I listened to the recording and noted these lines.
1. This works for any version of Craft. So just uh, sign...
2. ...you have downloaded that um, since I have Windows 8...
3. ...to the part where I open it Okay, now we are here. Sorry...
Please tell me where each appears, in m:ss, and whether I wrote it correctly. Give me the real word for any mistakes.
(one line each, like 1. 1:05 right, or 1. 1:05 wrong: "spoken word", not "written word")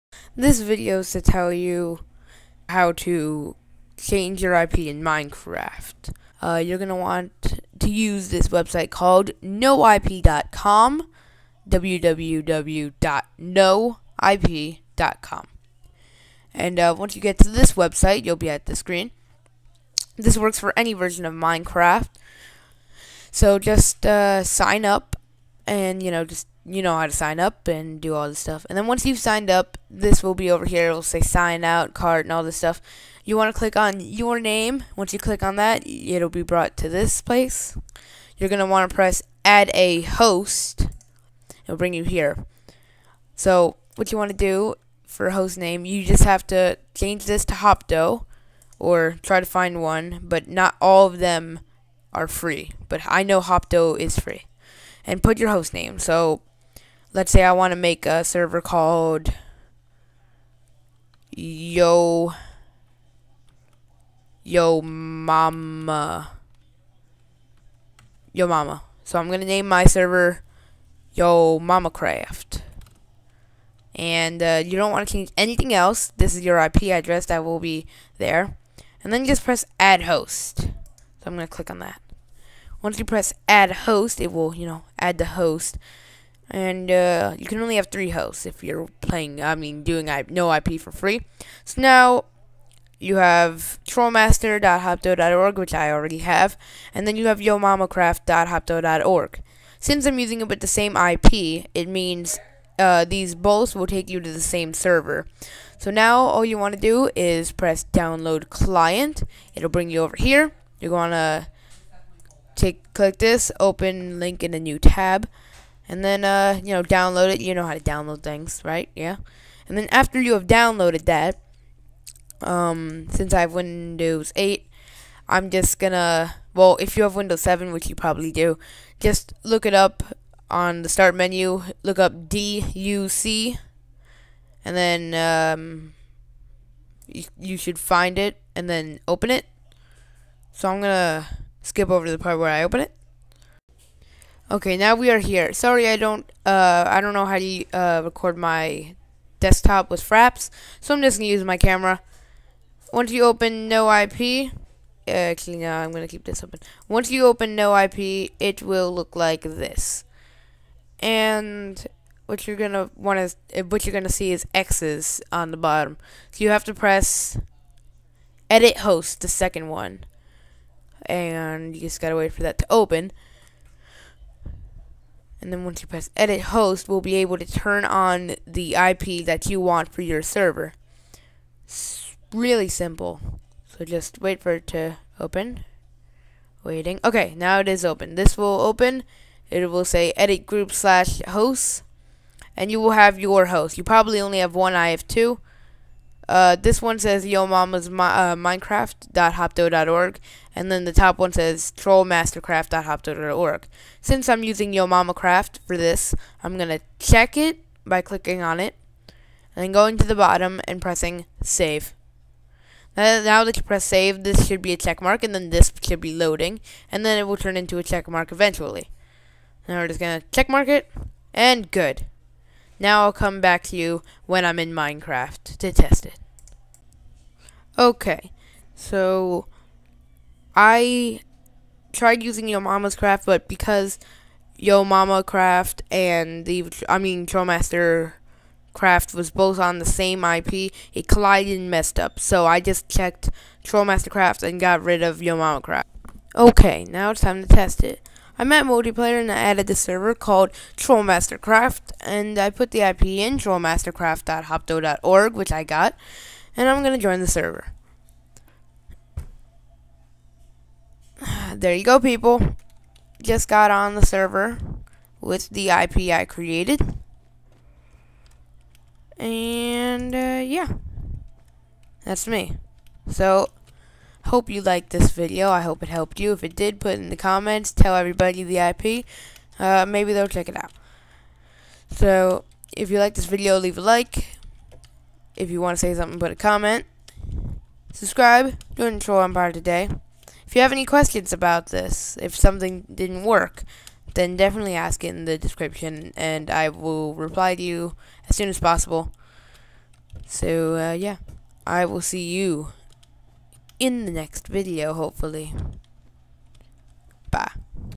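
1. 0:20 wrong: "Minecraft", not "Craft"
2. 2:00 right
3. 2:22 right.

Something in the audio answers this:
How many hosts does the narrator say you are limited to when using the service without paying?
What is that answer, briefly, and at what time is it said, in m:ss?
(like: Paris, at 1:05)
3, at 1:27.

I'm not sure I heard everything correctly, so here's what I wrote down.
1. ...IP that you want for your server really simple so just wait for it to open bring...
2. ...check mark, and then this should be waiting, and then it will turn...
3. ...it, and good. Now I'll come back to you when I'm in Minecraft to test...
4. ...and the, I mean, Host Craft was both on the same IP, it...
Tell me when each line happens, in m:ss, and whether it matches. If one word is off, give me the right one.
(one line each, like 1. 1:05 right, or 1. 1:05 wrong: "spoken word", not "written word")
1. 2:58 wrong: "waiting", not "bring"
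2. 3:34 wrong: "loading", not "waiting"
3. 3:40 right
4. 3:55 wrong: "Trollmaster", not "Host".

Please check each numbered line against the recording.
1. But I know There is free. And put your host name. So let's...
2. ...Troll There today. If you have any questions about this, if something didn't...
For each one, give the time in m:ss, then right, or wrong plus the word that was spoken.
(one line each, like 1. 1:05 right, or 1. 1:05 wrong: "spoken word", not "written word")
1. 0:52 wrong: "Hopto", not "There"
2. 4:48 wrong: "Empire", not "There".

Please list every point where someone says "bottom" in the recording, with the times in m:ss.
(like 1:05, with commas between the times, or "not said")
2:45, 3:30.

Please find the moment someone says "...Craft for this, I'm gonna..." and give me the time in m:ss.
3:25.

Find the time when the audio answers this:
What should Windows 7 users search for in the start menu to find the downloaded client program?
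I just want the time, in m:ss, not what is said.
2:12.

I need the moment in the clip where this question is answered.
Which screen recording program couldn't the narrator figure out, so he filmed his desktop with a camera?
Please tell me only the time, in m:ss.
2:30.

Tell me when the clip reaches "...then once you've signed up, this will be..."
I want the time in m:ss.
0:28.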